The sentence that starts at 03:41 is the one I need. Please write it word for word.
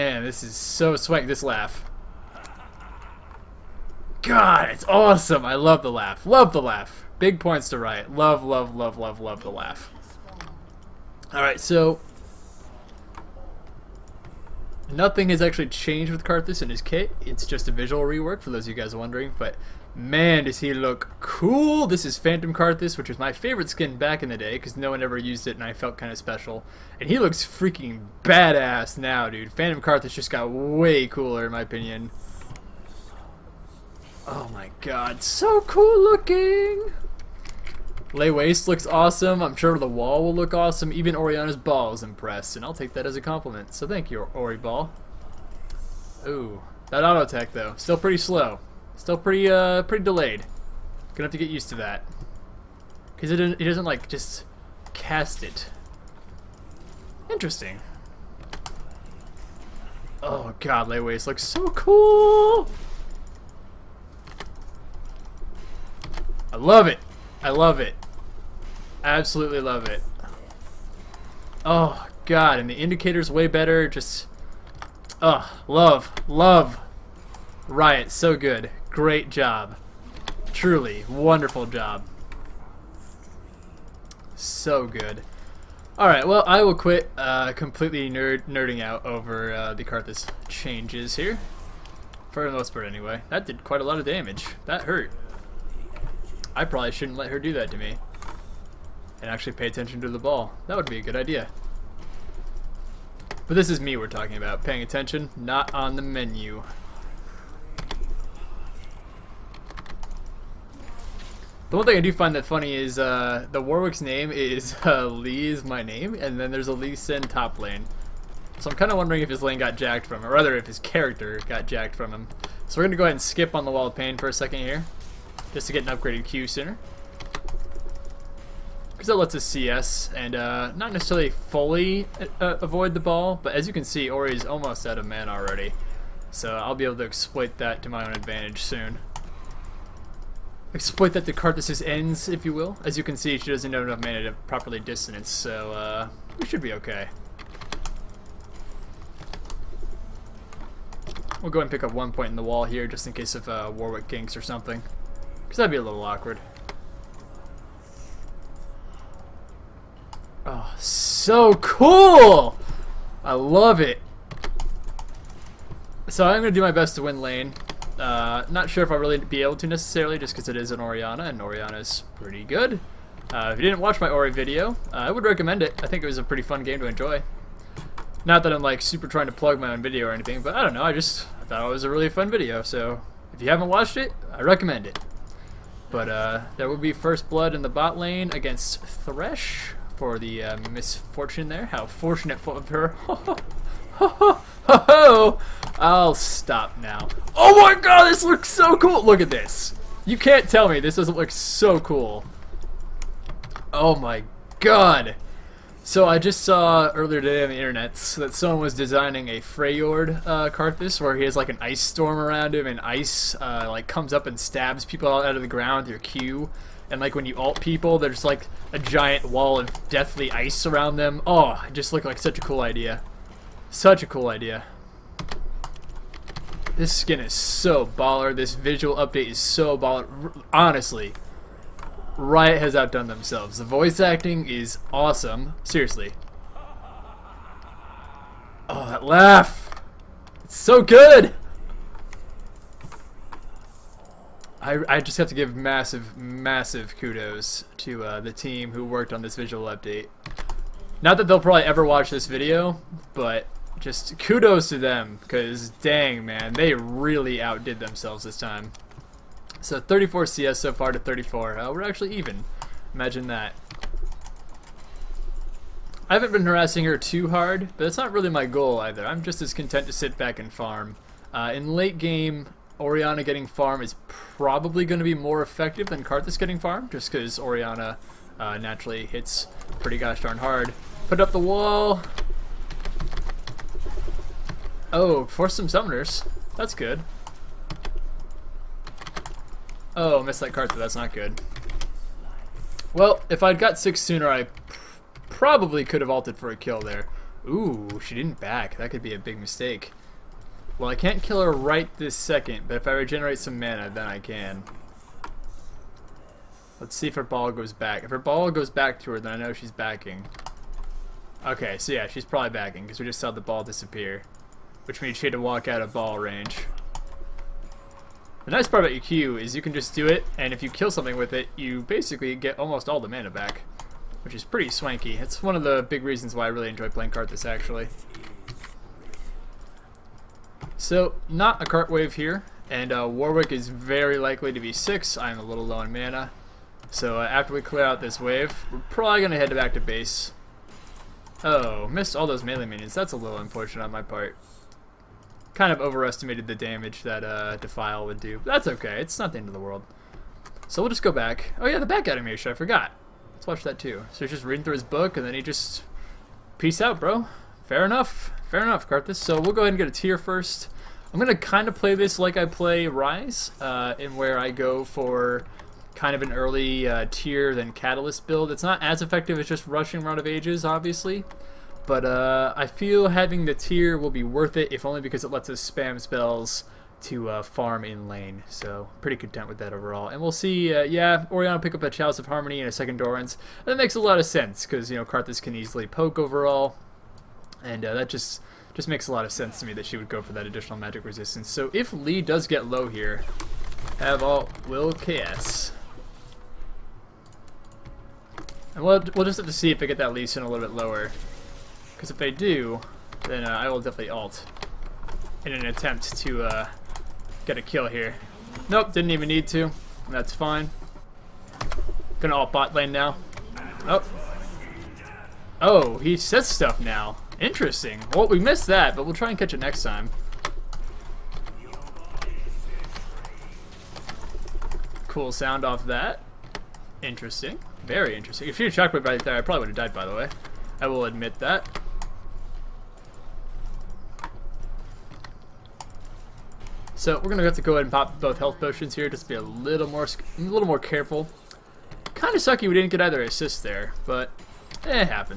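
Oh, it just looked like such a cool idea.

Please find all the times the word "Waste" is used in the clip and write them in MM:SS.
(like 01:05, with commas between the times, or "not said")
00:38, 01:00.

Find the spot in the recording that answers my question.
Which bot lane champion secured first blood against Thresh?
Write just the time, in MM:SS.
03:10.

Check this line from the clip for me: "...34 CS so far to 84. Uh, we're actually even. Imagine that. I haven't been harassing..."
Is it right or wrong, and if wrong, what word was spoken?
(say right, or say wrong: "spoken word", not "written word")
wrong: "34", not "84".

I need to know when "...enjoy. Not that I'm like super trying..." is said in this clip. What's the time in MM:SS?
02:56.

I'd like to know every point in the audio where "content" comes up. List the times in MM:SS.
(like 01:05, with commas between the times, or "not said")
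04:29, 06:19.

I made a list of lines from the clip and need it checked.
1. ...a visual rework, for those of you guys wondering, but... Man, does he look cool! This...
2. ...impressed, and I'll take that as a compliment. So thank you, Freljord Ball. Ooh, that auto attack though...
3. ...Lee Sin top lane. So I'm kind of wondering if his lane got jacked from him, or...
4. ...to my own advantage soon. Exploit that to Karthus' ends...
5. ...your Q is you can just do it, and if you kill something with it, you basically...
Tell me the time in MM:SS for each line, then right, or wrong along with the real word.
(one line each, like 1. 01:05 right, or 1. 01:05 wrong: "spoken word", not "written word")
1. 00:17 right
2. 00:42 wrong: "Ori", not "Freljord"
3. 01:56 right
4. 02:17 right
5. 05:18 right.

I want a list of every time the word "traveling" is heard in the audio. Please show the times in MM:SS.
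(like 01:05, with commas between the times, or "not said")
not said.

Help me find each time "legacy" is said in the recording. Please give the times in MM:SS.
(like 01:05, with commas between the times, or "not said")
not said.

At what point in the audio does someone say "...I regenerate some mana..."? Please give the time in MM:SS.
05:02.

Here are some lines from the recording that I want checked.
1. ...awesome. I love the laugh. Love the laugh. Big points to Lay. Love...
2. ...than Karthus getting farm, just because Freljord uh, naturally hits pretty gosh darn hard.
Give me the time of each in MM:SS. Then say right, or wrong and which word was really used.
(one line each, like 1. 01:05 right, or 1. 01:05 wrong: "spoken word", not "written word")
1. 00:04 wrong: "Riot", not "Lay"
2. 04:35 wrong: "Orianna", not "Freljord".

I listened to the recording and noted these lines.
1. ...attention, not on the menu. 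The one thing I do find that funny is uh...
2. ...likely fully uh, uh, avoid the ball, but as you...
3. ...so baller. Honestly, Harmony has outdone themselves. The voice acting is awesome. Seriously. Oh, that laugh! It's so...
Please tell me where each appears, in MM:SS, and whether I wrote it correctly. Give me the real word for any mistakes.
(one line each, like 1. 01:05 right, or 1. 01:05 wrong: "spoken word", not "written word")
1. 01:44 right
2. 02:10 wrong: "necessarily", not "likely"
3. 03:49 wrong: "Riot", not "Harmony".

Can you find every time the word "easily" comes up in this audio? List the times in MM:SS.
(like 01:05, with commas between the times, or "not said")
06:25.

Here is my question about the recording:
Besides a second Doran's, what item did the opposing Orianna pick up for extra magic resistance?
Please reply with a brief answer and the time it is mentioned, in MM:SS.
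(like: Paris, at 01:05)
Chalice of Harmony, at 06:21.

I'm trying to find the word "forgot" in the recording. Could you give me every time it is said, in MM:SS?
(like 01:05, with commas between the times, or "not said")
05:52.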